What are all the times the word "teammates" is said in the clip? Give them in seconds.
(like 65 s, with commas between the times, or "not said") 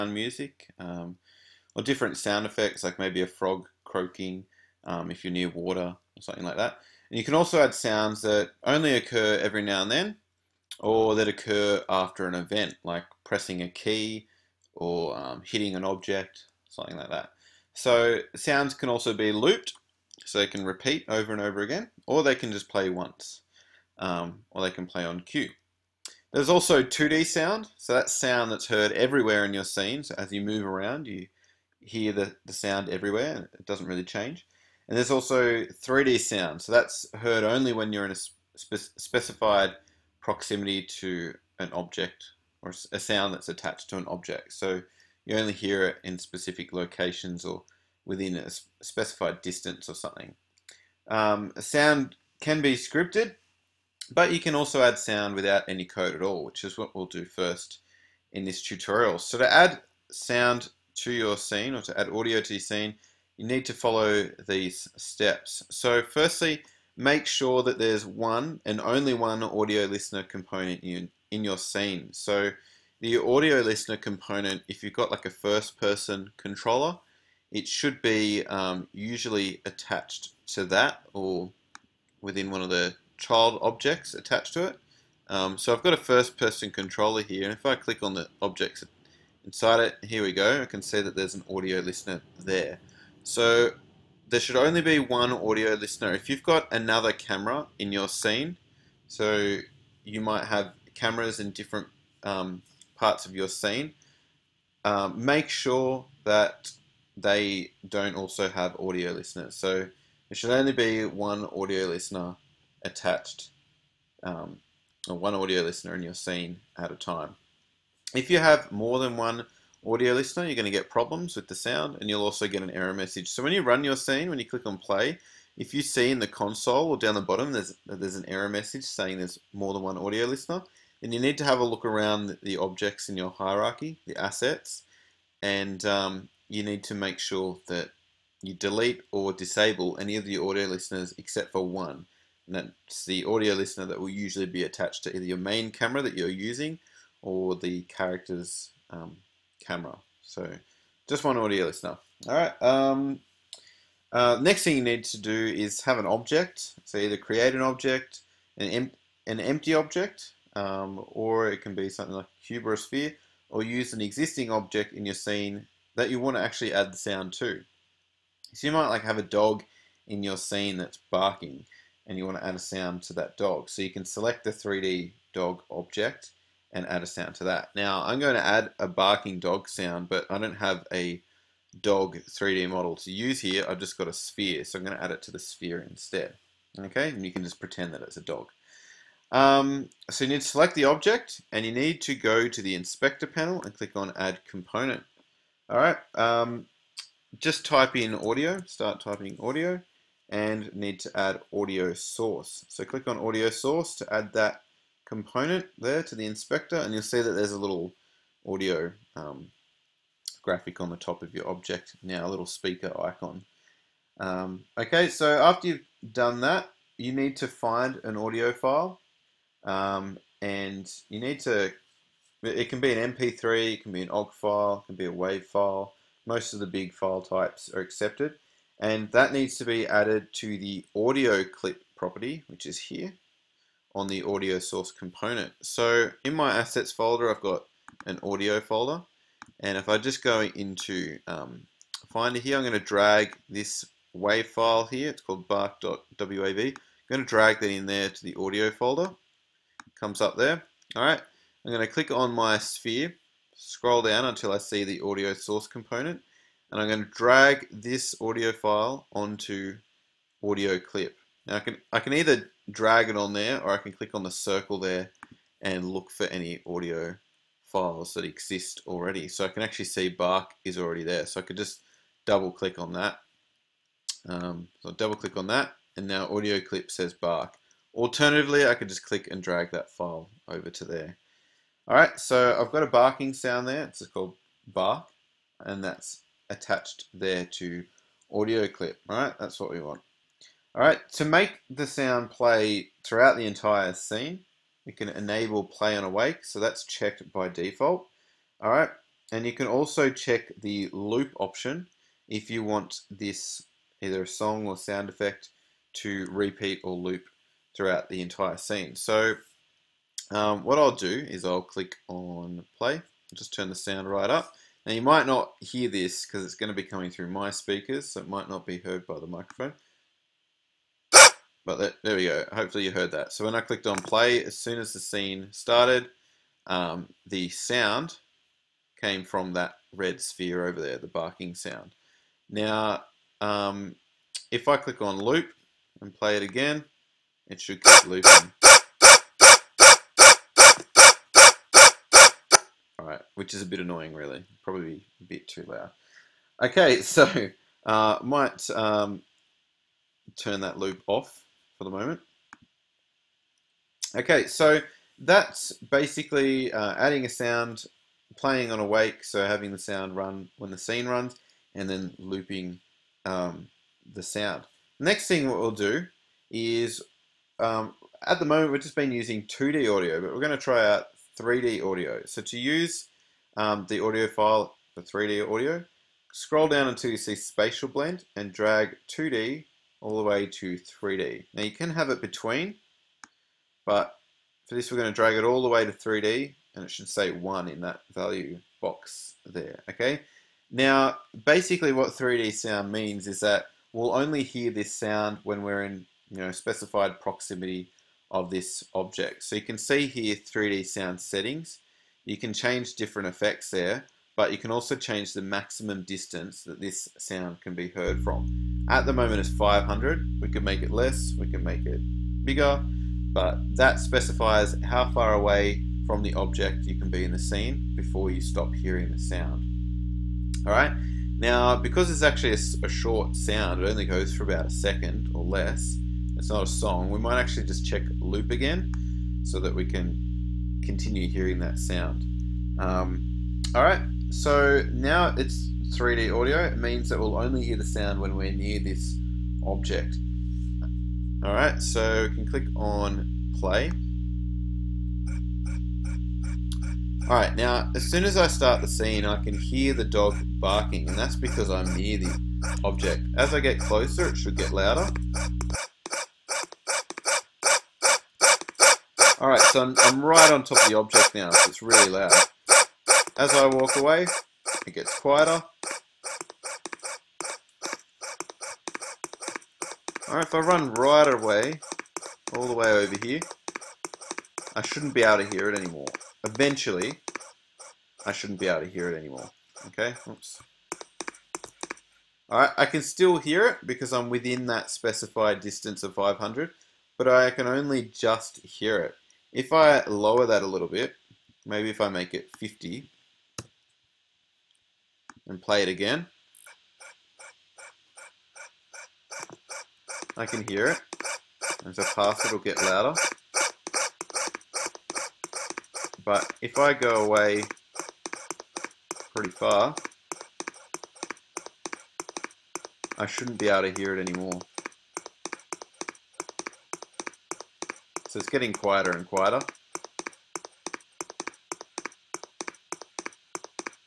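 not said.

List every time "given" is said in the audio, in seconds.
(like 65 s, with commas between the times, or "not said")
not said.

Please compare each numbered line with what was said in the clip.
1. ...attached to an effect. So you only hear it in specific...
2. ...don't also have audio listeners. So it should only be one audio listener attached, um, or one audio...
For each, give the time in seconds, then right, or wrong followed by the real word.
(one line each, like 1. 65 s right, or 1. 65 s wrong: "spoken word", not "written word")
1. 43 s wrong: "object", not "effect"
2. 107 s right.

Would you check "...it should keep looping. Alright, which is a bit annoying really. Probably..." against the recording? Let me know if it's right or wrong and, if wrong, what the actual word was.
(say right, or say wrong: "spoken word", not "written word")
right.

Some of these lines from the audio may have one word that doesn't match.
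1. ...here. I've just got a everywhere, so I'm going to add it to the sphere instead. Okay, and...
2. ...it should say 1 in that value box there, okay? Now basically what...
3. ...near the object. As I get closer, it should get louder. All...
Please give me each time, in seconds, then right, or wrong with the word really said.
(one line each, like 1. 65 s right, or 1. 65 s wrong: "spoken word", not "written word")
1. 183 s wrong: "sphere", not "everywhere"
2. 386 s right
3. 451 s right.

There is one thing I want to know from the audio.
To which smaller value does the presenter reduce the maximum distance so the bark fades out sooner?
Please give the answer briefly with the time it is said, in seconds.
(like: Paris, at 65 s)
50, at 492 s.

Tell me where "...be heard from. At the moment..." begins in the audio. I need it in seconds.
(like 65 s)
407 s.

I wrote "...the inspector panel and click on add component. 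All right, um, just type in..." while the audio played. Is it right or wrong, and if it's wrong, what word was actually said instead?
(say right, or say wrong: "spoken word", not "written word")
right.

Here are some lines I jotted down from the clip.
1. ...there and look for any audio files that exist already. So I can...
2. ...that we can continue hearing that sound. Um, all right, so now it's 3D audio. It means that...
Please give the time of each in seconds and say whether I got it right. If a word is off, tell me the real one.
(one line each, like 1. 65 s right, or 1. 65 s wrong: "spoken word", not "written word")
1. 264 s right
2. 429 s right.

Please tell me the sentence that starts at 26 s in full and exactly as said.
There's also 2D sound, so that's sound that's heard everywhere in your scene.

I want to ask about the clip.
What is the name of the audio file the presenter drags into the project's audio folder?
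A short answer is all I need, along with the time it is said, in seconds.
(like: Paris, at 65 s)
bark.wav, at 245 s.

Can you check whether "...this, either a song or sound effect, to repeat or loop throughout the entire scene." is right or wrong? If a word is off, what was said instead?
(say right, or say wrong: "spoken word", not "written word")
right.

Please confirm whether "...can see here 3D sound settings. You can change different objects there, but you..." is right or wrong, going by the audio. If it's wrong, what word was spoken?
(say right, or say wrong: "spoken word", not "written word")
wrong: "effects", not "objects".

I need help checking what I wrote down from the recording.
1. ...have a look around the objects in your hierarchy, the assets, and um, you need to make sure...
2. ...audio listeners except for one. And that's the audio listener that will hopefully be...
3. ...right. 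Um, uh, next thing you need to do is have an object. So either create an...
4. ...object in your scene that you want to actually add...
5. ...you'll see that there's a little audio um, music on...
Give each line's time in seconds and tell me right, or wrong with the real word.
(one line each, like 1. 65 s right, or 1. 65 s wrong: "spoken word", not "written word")
1. 131 s right
2. 140 s wrong: "usually", not "hopefully"
3. 152 s right
4. 164 s right
5. 206 s wrong: "graphic", not "music".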